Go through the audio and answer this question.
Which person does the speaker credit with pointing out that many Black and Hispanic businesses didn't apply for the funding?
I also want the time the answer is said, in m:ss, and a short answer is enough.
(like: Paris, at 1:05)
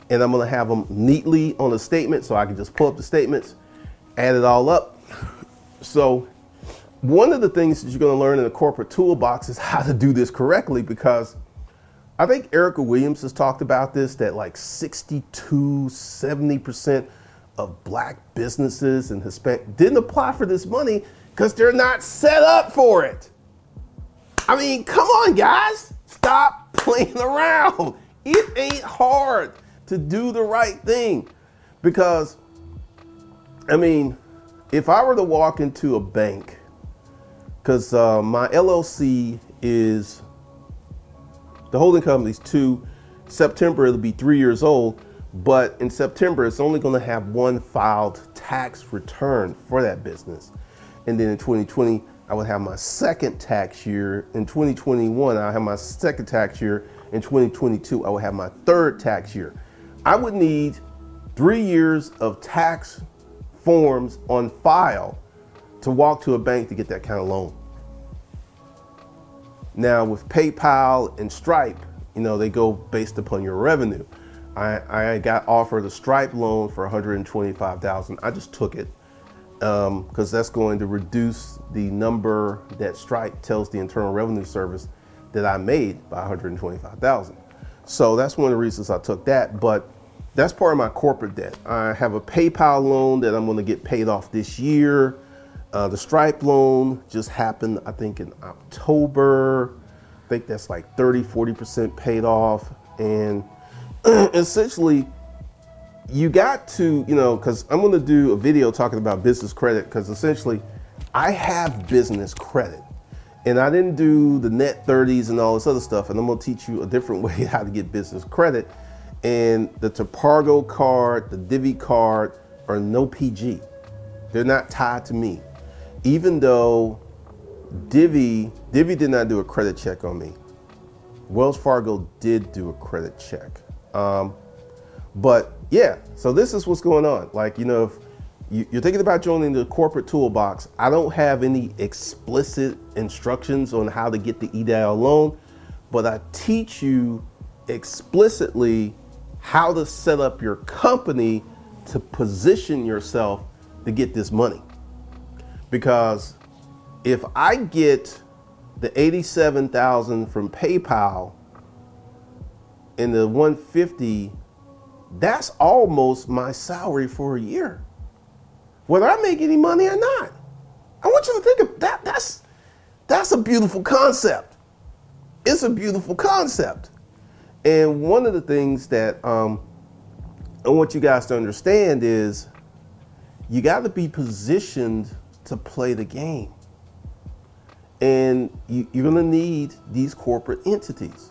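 Erica Williams, at 0:12.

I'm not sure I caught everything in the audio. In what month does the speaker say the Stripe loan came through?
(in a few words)
October.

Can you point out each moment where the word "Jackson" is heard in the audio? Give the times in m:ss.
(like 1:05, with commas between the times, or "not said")
not said.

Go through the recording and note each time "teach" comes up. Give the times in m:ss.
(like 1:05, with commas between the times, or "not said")
1:56, 2:26.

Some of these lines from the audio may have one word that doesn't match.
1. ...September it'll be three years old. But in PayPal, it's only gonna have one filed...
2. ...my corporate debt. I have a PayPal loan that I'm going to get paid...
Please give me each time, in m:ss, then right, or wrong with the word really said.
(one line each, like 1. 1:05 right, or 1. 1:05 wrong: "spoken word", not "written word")
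1. 0:43 wrong: "September", not "PayPal"
2. 1:30 right.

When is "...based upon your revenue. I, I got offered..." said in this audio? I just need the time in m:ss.
1:12.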